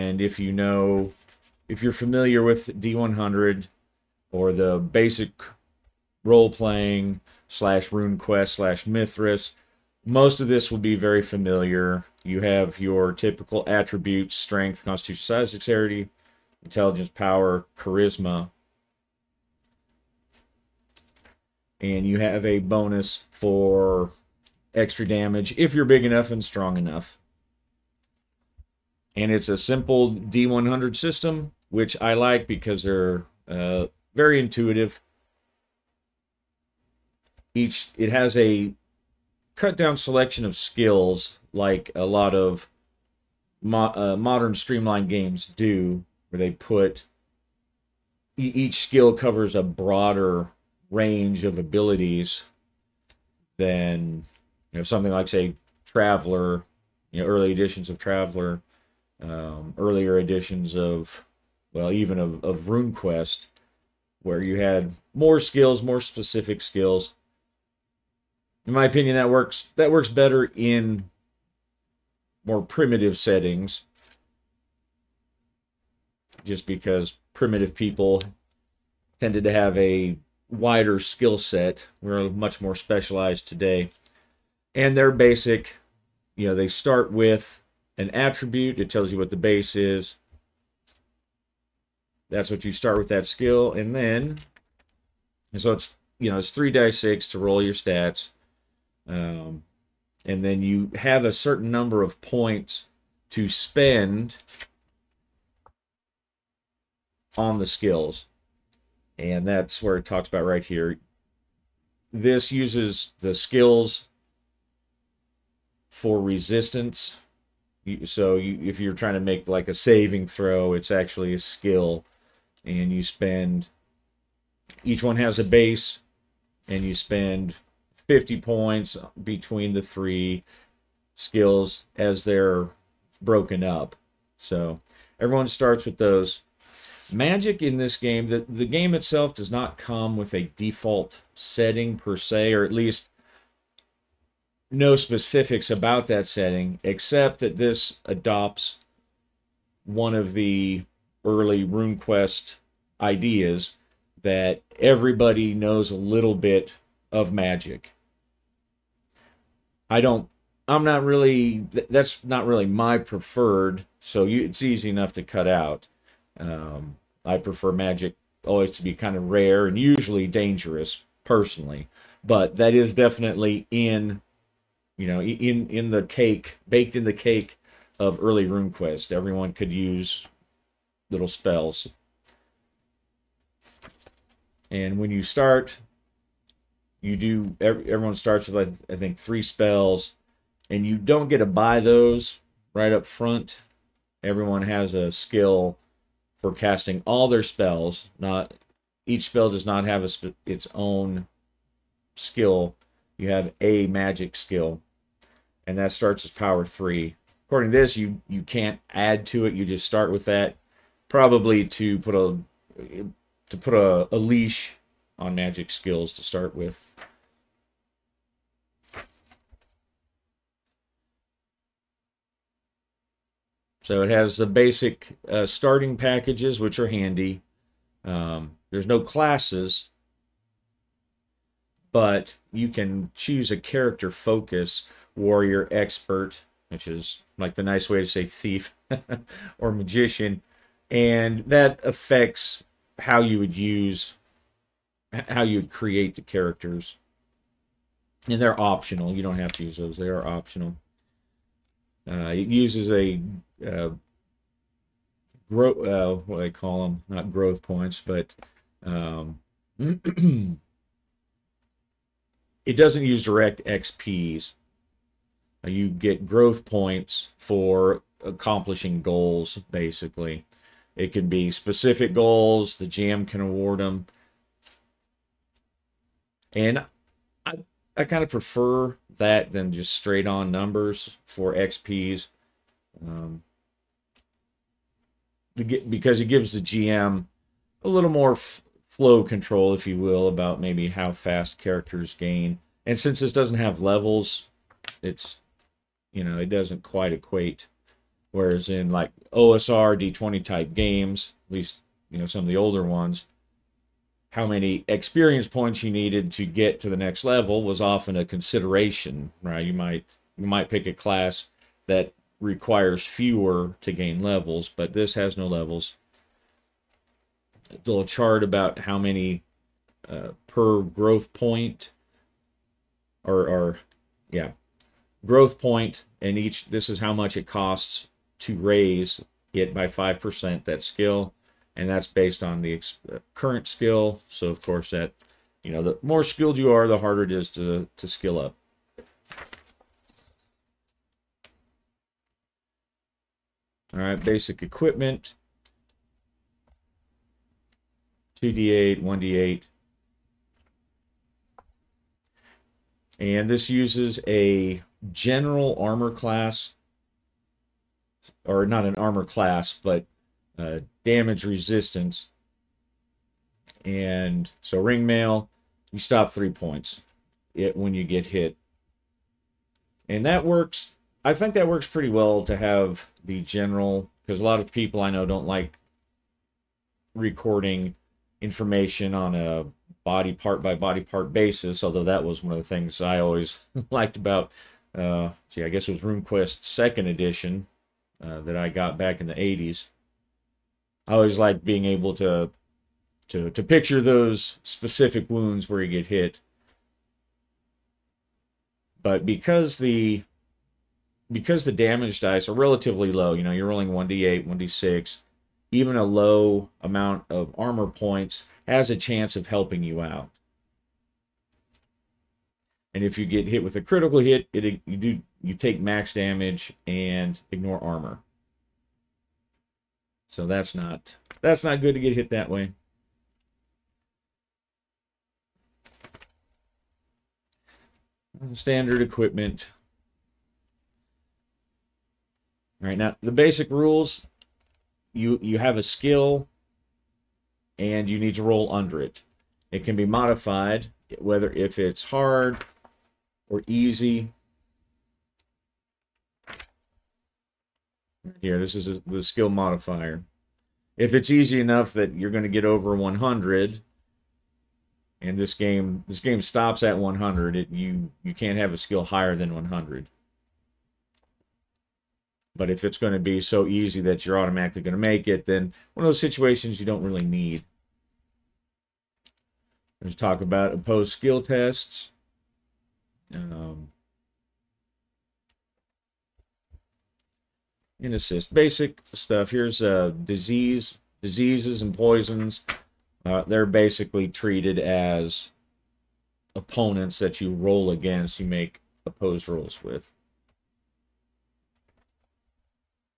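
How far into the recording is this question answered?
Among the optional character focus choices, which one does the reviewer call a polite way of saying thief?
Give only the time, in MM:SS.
03:55.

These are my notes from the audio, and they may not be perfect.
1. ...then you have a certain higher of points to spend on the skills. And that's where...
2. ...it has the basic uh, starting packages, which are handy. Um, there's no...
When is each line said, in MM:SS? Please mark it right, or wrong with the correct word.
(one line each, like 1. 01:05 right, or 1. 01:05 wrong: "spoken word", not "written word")
1. 01:40 wrong: "number", not "higher"
2. 03:44 right.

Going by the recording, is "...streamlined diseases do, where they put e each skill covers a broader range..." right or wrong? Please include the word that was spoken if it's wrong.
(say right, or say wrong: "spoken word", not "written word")
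wrong: "games", not "diseases".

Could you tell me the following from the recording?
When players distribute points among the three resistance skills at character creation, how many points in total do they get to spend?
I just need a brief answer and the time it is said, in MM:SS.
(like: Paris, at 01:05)
50, at 02:08.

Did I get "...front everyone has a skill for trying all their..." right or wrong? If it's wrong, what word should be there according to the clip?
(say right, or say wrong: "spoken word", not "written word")
wrong: "casting", not "trying".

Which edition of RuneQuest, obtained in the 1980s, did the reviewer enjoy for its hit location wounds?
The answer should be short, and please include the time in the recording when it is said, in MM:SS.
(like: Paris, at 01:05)
Second edition, at 06:26.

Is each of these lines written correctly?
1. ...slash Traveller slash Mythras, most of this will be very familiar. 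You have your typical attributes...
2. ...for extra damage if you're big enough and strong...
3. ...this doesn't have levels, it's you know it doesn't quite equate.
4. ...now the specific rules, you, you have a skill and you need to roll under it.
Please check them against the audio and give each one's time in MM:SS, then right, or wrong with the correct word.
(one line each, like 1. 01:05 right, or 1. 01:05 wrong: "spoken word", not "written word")
1. 00:07 wrong: "RuneQuest", not "Traveller"
2. 00:23 right
3. 04:53 right
4. 07:12 wrong: "basic", not "specific".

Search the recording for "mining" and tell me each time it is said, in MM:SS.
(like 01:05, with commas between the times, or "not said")
not said.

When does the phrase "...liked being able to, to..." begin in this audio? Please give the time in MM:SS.
06:31.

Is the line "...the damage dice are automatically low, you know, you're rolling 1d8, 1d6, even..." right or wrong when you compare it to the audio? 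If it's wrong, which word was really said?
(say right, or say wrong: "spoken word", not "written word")
wrong: "relatively", not "automatically".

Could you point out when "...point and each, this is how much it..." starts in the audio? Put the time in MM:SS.
05:25.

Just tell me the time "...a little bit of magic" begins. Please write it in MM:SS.
02:35.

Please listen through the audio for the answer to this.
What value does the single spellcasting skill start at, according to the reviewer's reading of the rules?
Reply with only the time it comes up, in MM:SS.
03:26.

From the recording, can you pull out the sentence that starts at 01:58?
So you, if you're trying to make like a saving throw, it's actually a skill.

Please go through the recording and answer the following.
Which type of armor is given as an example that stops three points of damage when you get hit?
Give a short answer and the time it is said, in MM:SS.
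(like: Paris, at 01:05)
Ring mail, at 06:04.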